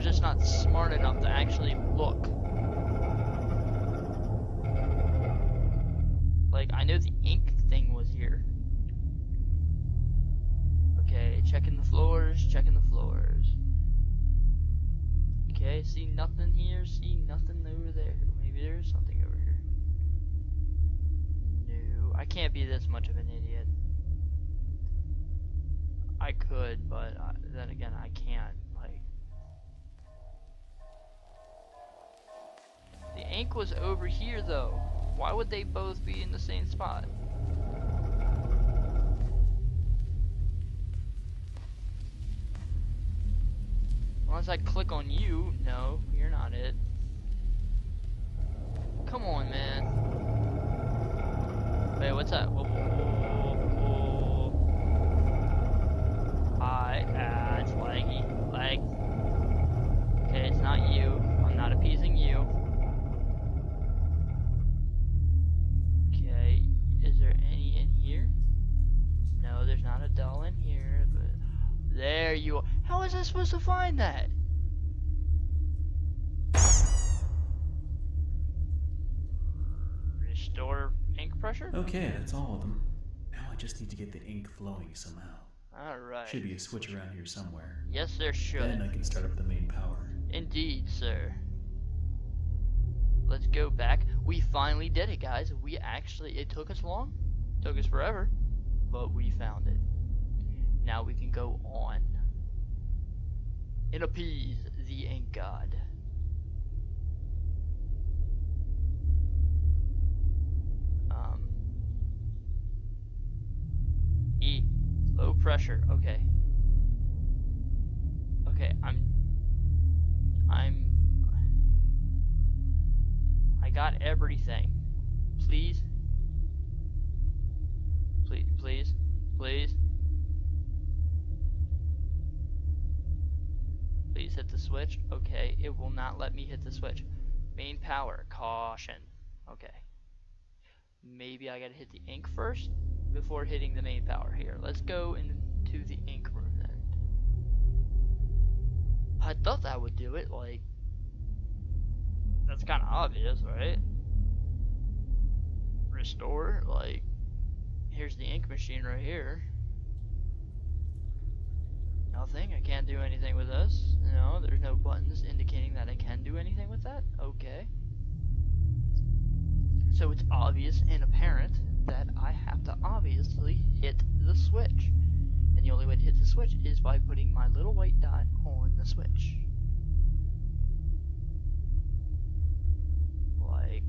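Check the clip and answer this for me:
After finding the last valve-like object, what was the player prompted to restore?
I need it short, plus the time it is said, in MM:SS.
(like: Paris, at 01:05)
Ink pressure, at 01:20.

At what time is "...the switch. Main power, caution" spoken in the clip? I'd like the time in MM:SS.
02:16.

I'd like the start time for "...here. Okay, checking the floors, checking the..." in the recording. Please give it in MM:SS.
00:08.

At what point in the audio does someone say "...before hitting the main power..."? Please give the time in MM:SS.
02:23.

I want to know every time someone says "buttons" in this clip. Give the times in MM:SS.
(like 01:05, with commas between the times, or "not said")
02:44.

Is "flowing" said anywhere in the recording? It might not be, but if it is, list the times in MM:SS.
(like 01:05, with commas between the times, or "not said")
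01:24.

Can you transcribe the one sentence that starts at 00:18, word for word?
Maybe there is something over here.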